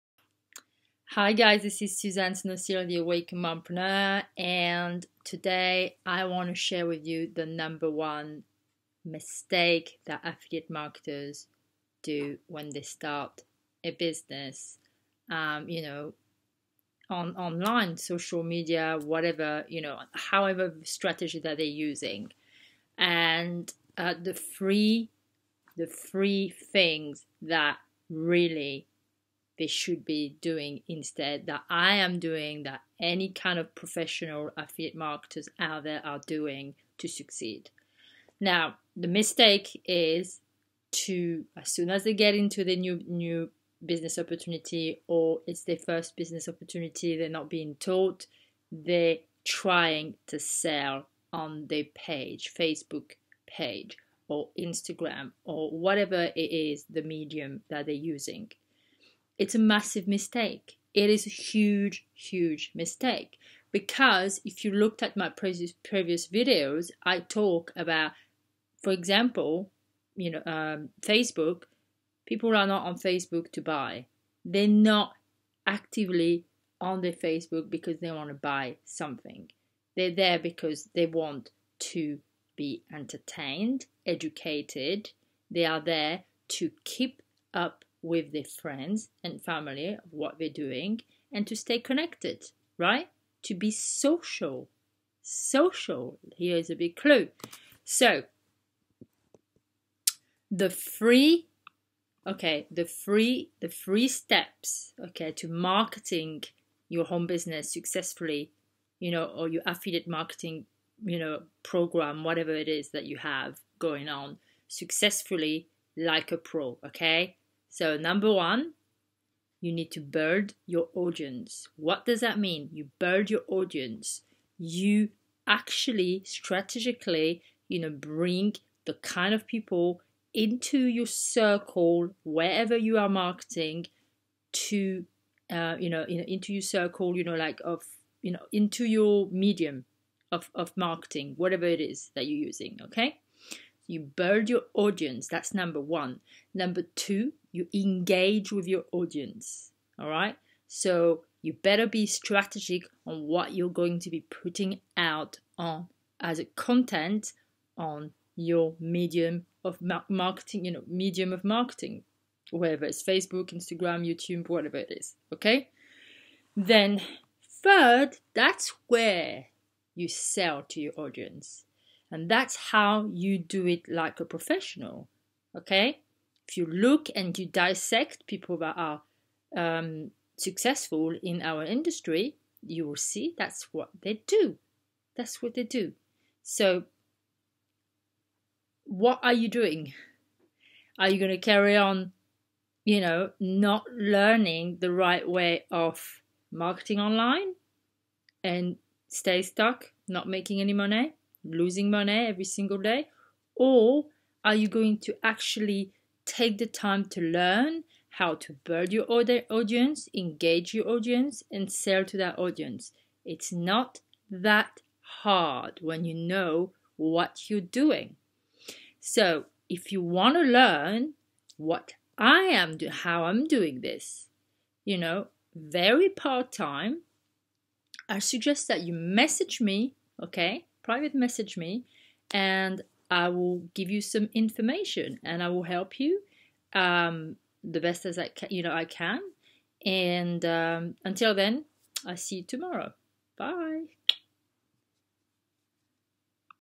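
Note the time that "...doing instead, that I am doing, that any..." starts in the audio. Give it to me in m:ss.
0:30.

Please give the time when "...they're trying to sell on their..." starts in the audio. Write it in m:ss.
0:48.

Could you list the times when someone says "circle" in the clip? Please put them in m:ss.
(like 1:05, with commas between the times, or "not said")
2:11, 2:16.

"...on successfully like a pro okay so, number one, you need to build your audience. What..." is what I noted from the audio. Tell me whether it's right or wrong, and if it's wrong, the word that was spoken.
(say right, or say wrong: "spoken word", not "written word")
right.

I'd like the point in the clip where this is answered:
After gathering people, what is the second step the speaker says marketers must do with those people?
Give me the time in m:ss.
2:27.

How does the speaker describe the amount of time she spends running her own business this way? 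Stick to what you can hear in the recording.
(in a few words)
Very part time.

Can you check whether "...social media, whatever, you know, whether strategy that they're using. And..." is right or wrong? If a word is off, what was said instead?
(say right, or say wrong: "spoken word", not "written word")
wrong: "however", not "whether".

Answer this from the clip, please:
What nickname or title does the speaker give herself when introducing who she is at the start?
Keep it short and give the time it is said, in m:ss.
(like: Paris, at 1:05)
The Awake Mompreneur, at 0:02.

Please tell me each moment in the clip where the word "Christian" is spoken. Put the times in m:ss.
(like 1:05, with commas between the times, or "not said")
not said.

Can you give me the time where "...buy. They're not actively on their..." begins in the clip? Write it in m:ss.
1:13.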